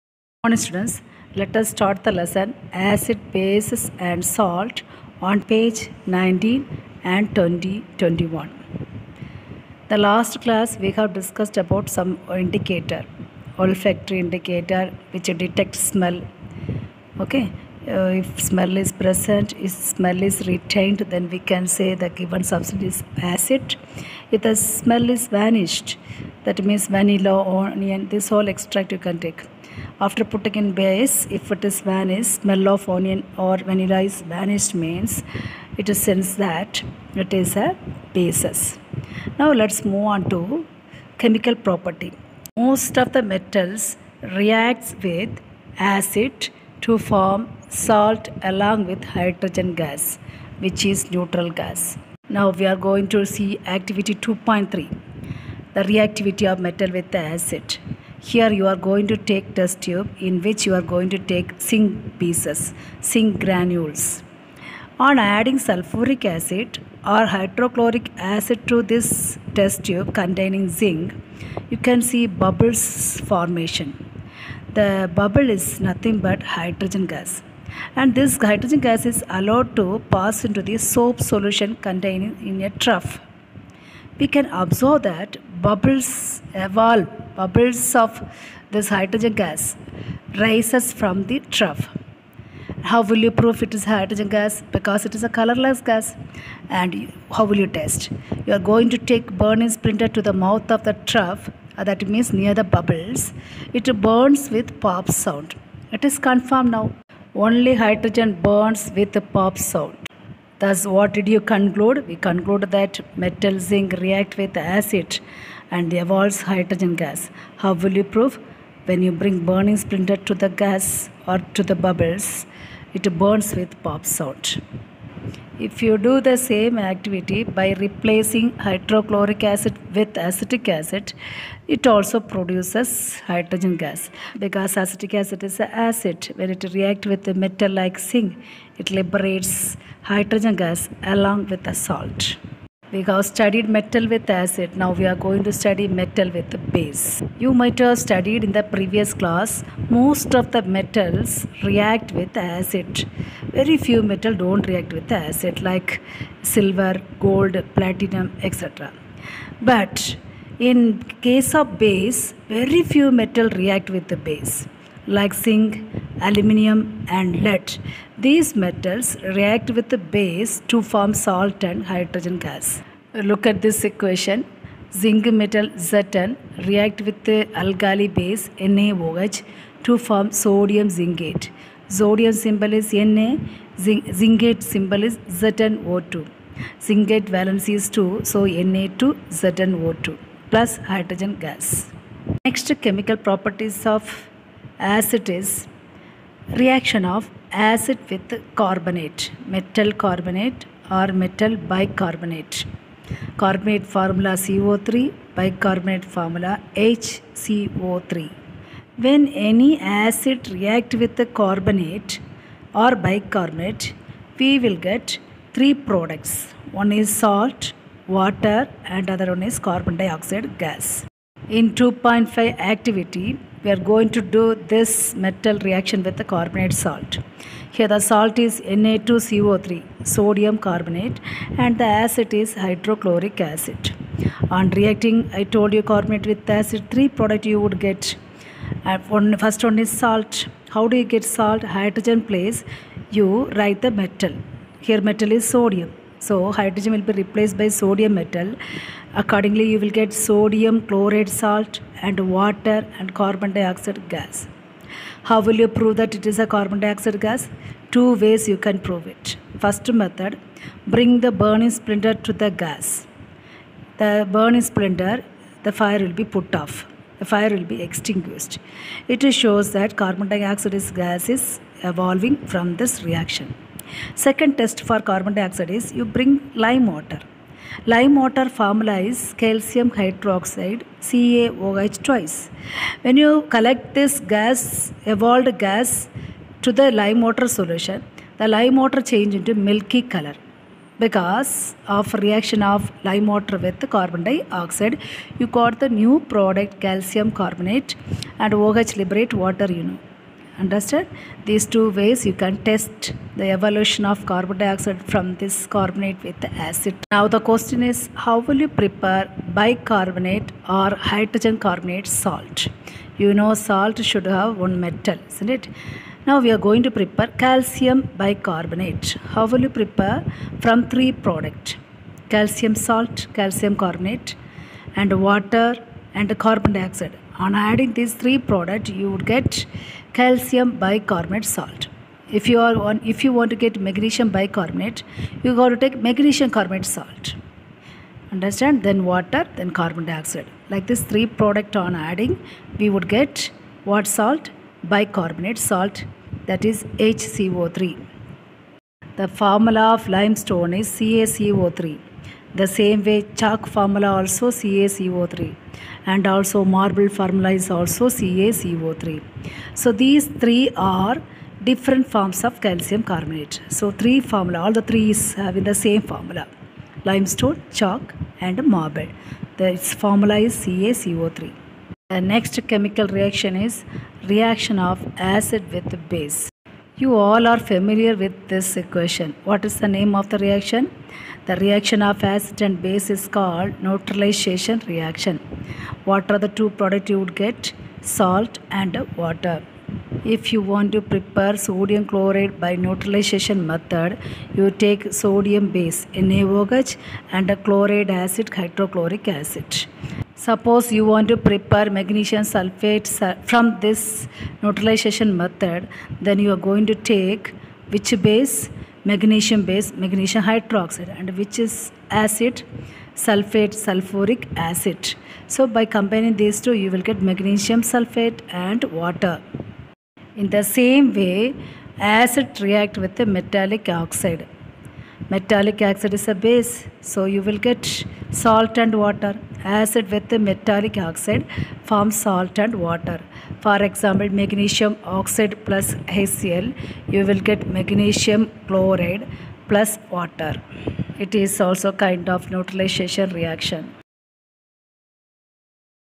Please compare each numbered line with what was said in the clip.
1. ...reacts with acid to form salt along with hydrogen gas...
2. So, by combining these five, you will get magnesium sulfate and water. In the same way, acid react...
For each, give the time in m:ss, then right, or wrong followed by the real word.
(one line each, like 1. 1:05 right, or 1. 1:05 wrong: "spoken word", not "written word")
1. 0:44 right
2. 6:55 wrong: "two", not "five".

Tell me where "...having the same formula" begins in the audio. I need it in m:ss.
6:05.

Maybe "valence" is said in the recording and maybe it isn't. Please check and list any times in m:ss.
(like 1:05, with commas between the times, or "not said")
3:07.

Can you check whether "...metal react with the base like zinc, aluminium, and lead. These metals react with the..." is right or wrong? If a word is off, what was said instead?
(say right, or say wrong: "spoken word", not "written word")
right.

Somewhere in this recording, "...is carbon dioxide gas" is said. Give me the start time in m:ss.
3:39.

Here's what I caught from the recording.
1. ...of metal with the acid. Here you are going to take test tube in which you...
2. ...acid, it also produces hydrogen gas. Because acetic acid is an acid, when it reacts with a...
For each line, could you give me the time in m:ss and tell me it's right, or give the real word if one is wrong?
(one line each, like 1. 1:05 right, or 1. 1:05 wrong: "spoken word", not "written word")
1. 0:56 right
2. 2:10 right.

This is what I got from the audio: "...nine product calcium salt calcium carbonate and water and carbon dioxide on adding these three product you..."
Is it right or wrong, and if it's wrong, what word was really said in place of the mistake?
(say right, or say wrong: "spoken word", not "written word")
wrong: "three", not "nine".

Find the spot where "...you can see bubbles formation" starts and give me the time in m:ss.
1:11.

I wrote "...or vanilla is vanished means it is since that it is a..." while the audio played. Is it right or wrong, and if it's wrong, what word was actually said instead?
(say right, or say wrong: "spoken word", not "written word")
right.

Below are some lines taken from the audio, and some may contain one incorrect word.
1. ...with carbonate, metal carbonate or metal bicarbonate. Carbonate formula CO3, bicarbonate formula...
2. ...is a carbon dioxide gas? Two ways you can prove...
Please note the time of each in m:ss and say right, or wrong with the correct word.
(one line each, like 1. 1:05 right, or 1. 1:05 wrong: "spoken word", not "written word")
1. 3:18 right
2. 4:16 right.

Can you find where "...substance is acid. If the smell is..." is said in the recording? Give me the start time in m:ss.
0:22.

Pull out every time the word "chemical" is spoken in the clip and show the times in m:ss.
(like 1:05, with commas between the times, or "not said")
0:41, 3:12, 6:12.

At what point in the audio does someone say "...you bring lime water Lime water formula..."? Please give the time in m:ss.
4:35.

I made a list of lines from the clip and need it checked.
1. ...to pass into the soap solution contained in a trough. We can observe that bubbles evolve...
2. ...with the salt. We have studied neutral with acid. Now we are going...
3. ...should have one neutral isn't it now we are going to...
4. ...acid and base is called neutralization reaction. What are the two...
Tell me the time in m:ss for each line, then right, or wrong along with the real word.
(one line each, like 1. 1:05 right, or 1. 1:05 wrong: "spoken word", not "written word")
1. 1:19 right
2. 2:21 wrong: "metal", not "neutral"
3. 5:14 wrong: "metal", not "neutral"
4. 6:22 right.